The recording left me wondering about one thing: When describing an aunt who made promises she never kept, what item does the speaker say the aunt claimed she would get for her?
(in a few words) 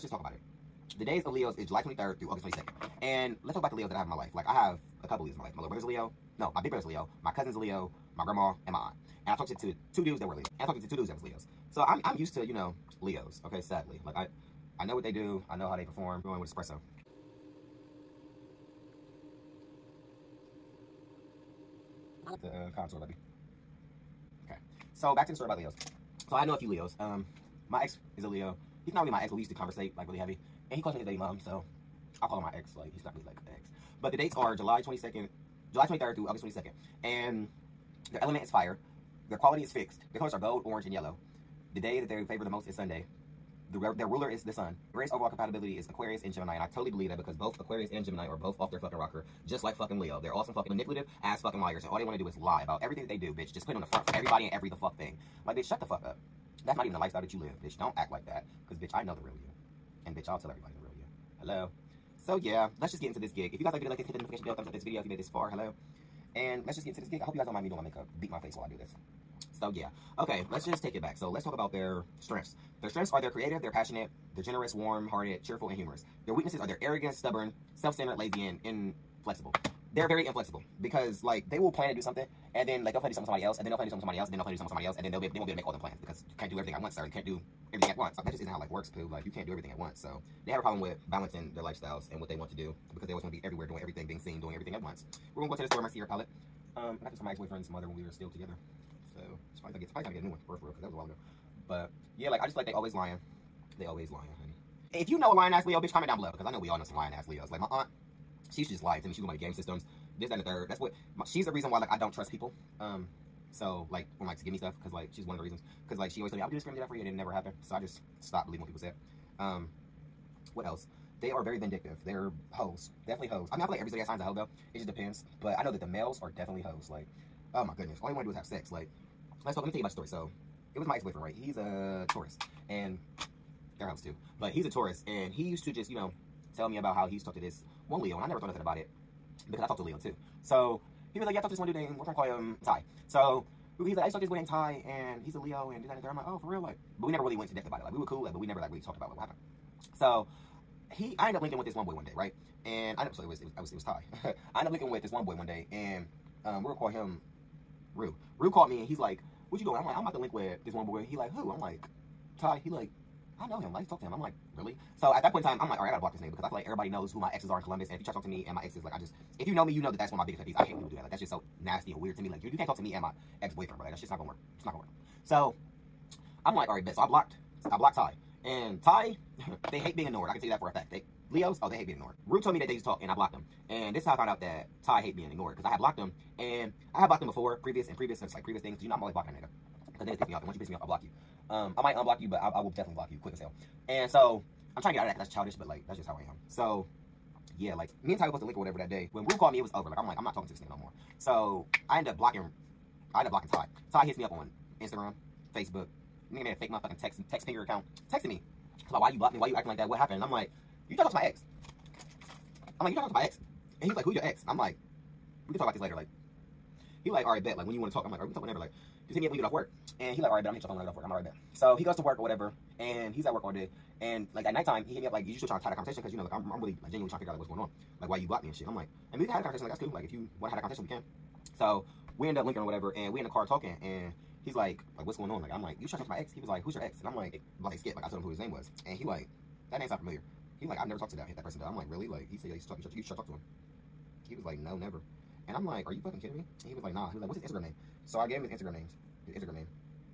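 Game systems.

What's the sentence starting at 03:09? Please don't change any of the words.
Because niggas piss me off, and once you piss me off, I block you.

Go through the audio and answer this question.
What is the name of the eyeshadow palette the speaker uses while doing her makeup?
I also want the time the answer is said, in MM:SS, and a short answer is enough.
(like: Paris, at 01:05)
Sierra palette, at 01:35.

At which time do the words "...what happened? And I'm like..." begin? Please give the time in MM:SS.
03:29.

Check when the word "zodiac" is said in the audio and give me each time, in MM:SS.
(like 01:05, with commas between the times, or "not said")
02:03.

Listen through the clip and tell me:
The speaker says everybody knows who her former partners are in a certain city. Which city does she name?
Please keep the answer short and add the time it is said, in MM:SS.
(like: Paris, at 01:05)
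Columbus, at 02:47.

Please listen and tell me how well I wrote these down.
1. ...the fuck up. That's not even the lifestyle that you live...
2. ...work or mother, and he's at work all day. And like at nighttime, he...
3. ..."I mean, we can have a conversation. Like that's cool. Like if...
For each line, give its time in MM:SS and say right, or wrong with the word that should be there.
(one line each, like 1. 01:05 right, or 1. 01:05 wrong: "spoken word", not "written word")
1. 00:55 right
2. 03:41 wrong: "whatever", not "mother"
3. 03:49 right.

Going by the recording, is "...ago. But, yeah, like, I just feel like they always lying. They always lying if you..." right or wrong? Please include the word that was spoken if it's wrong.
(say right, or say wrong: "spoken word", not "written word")
right.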